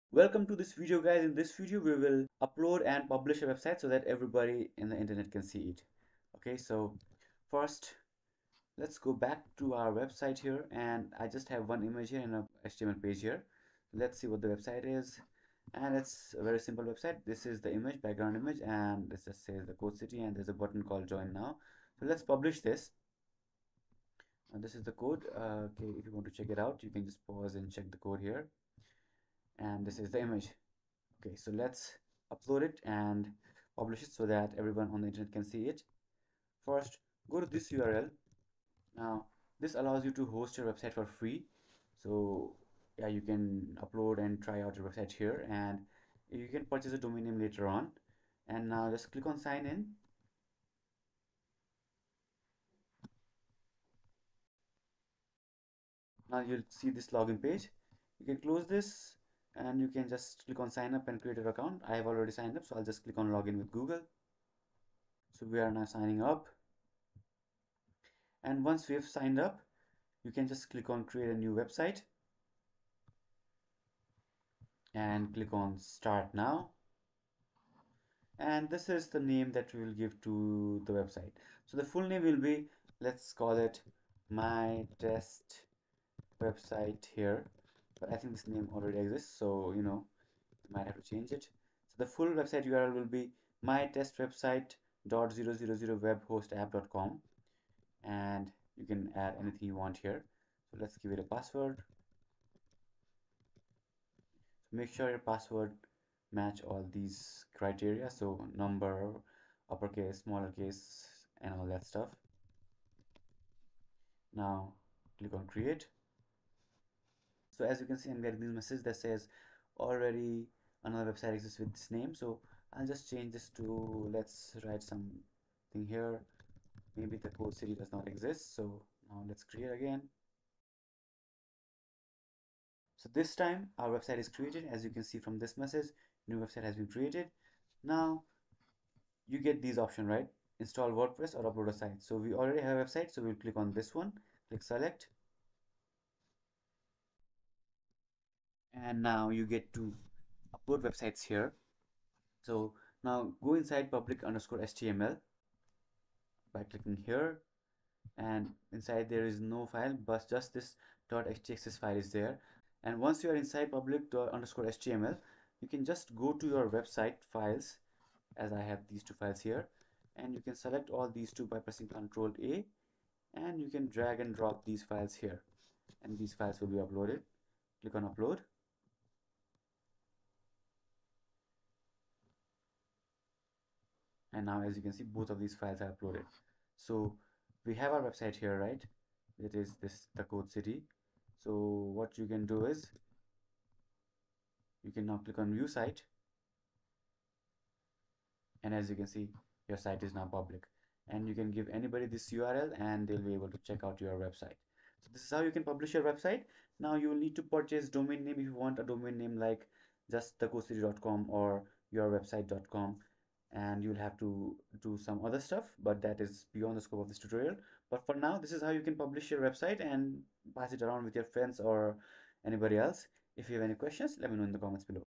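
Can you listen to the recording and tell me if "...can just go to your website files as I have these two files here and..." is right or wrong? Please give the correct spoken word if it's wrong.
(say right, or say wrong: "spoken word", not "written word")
right.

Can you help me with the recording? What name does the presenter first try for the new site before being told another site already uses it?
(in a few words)
My test website.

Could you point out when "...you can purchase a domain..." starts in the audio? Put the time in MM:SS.
00:46.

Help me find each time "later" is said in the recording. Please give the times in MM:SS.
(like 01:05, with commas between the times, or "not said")
00:47.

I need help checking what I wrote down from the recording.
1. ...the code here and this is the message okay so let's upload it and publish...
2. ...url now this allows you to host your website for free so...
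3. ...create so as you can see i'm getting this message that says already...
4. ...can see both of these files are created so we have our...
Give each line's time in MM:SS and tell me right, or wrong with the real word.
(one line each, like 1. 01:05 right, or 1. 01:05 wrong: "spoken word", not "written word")
1. 00:27 wrong: "image", not "message"
2. 00:37 right
3. 01:55 right
4. 03:04 wrong: "uploaded", not "created".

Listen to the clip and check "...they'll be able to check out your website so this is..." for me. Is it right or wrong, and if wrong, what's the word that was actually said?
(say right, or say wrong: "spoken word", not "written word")
right.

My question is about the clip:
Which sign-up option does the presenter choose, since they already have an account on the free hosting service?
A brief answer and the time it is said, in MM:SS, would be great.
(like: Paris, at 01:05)
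Login with Google, at 01:03.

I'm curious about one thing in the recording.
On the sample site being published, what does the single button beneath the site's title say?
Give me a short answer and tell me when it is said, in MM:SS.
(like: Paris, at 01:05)
Join now, at 00:21.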